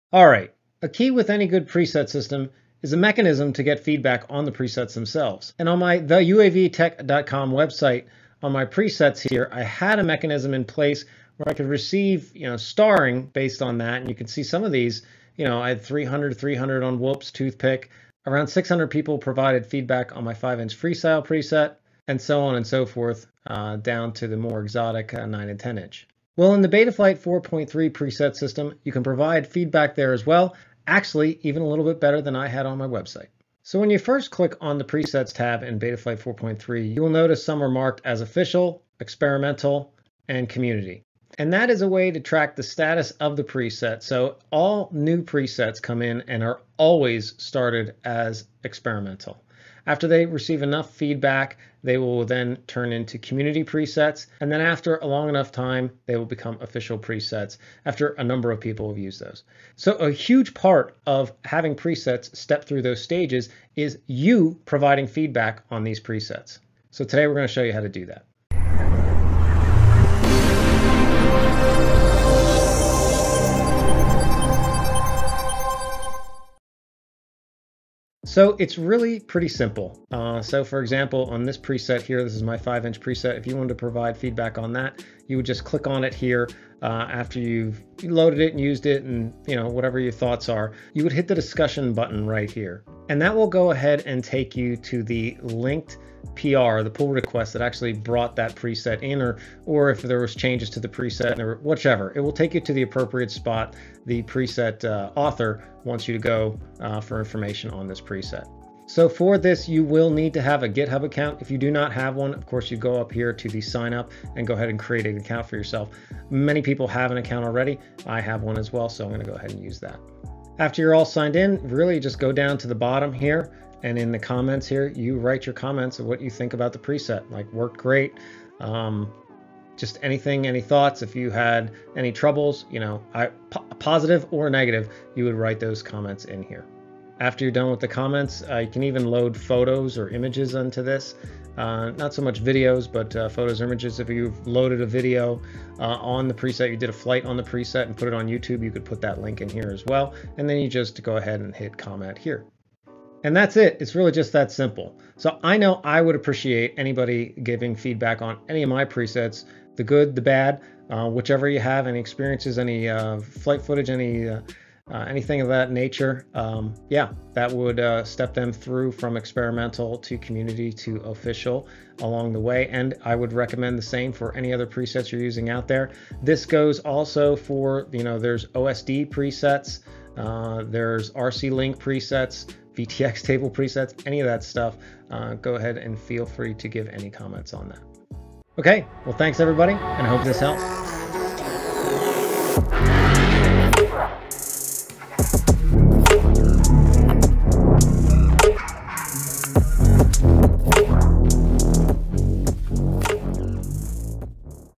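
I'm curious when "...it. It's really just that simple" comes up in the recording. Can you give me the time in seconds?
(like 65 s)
153 s.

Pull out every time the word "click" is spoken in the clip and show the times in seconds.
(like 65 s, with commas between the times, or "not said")
34 s, 85 s.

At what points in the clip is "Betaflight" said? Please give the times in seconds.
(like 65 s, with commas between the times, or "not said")
26 s, 35 s.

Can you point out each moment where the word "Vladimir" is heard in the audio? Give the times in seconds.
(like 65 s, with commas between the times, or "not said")
not said.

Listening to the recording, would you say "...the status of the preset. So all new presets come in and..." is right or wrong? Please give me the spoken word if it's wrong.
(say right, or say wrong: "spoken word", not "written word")
right.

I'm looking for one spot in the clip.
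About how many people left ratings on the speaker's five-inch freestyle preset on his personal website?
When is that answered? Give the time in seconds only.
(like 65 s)
18 s.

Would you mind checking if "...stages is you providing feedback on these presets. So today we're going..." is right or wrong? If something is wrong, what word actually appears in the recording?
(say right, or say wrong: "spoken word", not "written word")
right.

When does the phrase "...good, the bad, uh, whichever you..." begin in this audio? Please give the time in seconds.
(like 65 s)
159 s.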